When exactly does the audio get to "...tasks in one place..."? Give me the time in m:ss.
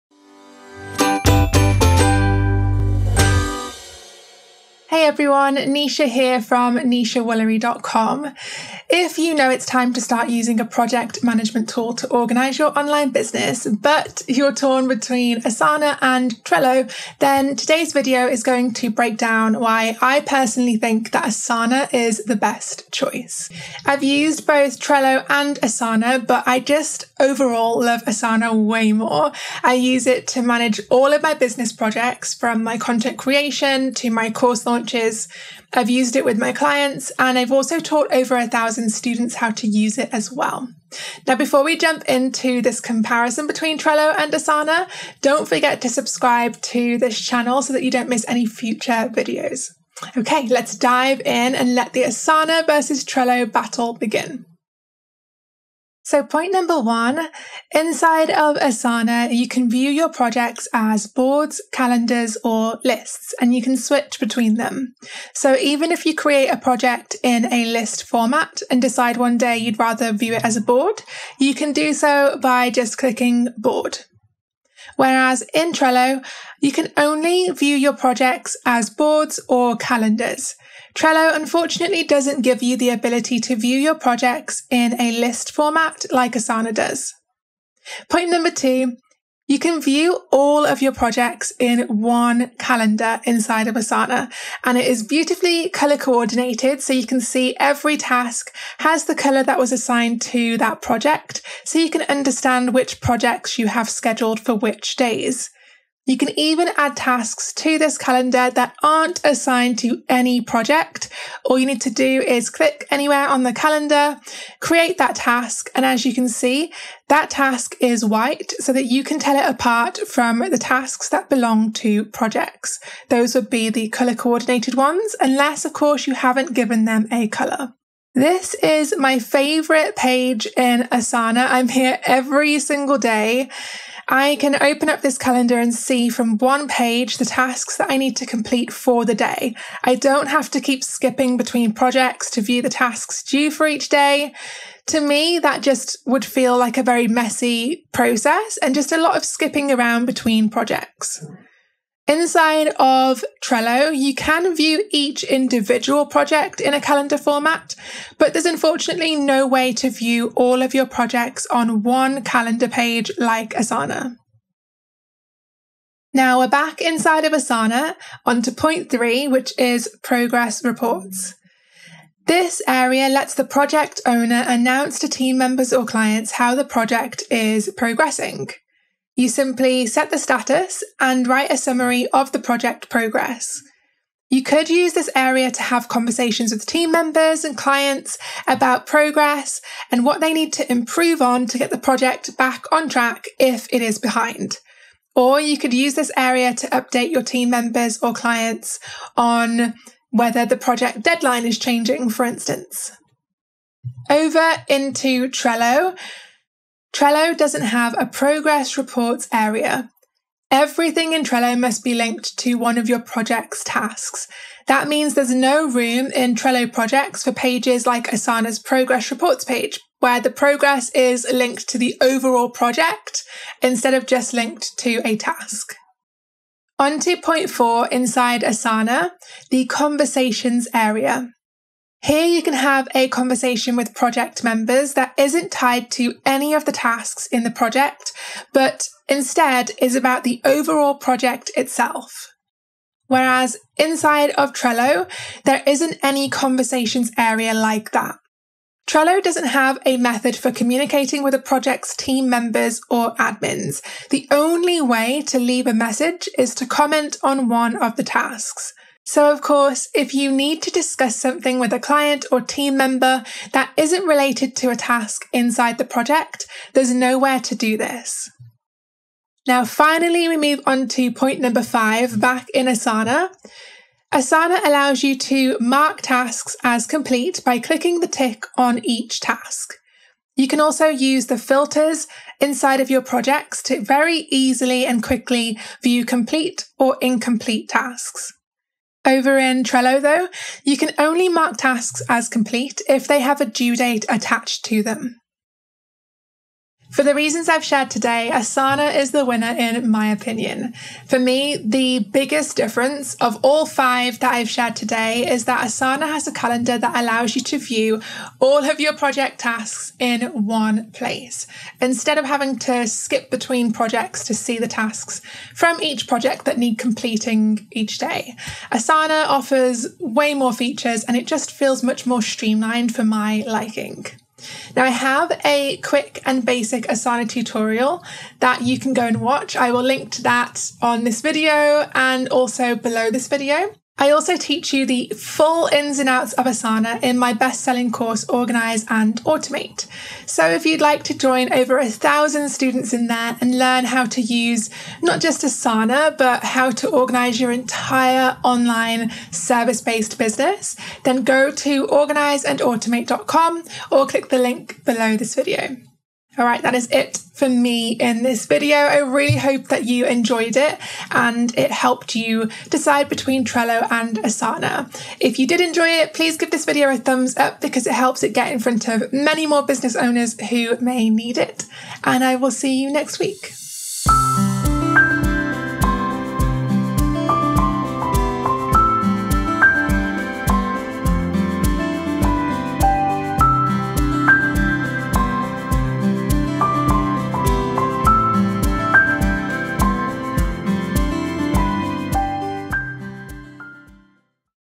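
5:09.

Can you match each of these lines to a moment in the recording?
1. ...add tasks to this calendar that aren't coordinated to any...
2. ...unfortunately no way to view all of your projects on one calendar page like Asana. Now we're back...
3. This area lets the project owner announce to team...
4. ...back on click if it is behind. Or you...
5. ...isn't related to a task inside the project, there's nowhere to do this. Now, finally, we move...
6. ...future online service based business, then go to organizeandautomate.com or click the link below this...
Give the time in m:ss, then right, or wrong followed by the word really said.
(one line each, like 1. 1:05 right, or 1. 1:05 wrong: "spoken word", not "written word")
1. 1:46 wrong: "assigned", not "coordinated"
2. 2:38 right
3. 2:52 right
4. 3:12 wrong: "track", not "click"
5. 4:23 right
6. 5:47 wrong: "entire", not "future".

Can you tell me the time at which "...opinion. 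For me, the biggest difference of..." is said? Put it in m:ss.
5:00.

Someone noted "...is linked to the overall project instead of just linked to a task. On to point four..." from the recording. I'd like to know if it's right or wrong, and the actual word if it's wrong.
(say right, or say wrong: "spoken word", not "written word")
right.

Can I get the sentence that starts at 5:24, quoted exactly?
Now I have a quick and basic Asana tutorial that you can go and watch.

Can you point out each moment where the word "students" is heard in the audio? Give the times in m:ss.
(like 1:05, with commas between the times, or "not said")
0:38, 5:42.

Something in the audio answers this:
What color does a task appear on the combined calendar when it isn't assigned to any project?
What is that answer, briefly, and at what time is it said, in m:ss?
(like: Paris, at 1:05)
white, at 1:58.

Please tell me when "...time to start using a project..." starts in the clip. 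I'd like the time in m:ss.
0:09.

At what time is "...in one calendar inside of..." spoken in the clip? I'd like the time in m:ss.
1:31.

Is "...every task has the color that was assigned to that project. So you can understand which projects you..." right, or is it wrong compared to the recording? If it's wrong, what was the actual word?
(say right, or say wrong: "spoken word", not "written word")
right.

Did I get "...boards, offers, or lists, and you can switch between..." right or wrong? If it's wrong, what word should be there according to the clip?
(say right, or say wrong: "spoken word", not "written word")
wrong: "calendars", not "offers".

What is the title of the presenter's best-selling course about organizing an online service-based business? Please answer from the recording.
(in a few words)
Organize and Automate.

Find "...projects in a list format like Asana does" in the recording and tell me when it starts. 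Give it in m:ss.
1:23.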